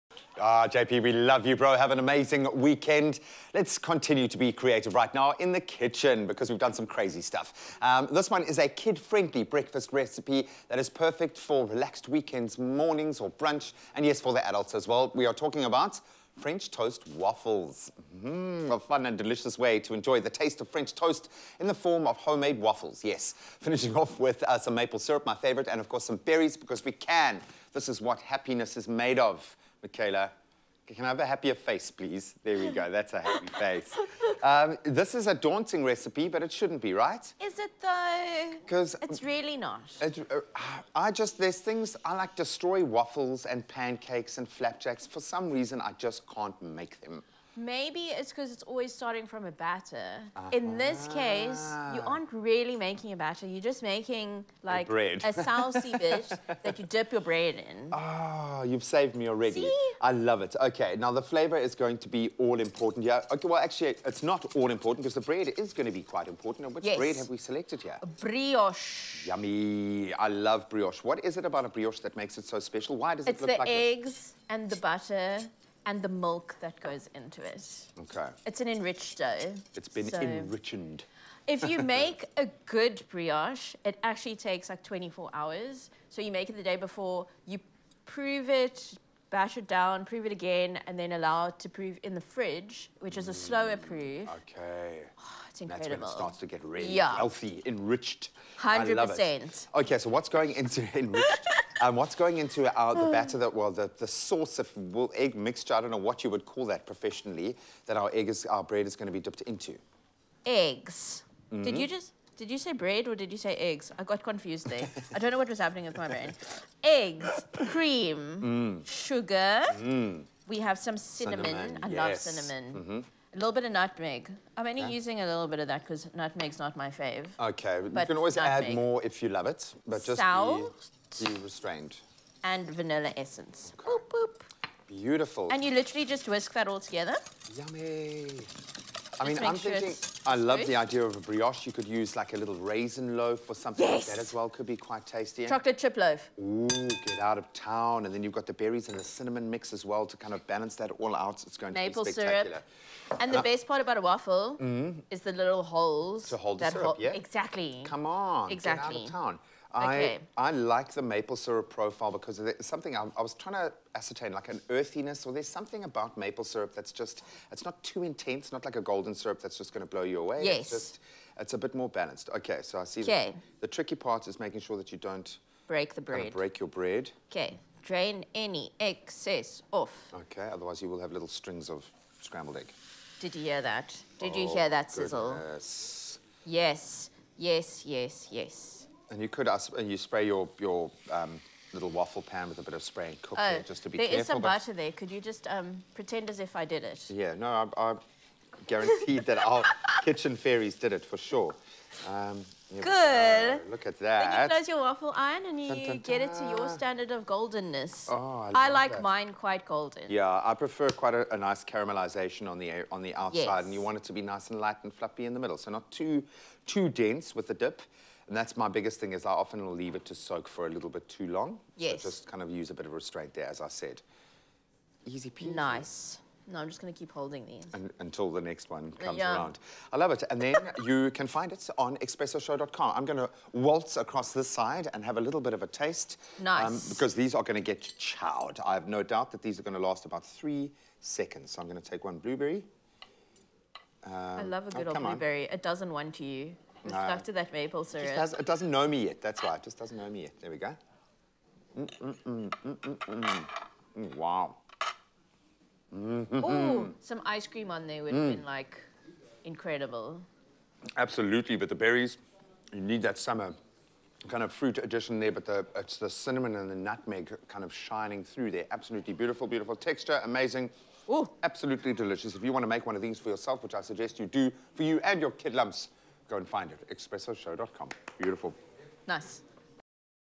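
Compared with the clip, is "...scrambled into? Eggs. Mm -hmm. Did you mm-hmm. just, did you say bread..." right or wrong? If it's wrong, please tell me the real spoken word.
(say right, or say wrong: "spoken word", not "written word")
wrong: "dipped", not "scrambled".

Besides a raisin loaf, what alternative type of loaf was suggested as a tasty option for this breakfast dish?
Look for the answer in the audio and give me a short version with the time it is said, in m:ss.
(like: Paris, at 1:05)
Chocolate chip loaf, at 2:25.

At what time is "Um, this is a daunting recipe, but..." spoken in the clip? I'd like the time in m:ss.
0:34.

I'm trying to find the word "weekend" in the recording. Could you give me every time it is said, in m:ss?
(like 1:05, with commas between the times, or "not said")
0:02, 0:12.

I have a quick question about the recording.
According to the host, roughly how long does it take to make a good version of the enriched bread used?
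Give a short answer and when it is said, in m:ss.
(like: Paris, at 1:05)
24 hours, at 1:24.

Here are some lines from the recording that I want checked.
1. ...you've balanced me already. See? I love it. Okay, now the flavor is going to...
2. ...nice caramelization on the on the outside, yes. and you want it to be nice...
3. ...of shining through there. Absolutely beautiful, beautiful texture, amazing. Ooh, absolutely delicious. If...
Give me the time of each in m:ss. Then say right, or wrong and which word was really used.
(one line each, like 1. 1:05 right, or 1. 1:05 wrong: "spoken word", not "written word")
1. 0:58 wrong: "saved", not "balanced"
2. 3:31 right
3. 4:27 right.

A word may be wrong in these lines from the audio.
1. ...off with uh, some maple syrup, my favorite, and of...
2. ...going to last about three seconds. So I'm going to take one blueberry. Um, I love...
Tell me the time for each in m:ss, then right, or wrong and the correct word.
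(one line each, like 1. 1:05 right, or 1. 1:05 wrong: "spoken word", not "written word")
1. 0:23 right
2. 3:59 right.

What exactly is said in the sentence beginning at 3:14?
Could you just um, pretend as if I did it?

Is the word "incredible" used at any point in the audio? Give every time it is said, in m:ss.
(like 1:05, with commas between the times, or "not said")
1:35, 4:19.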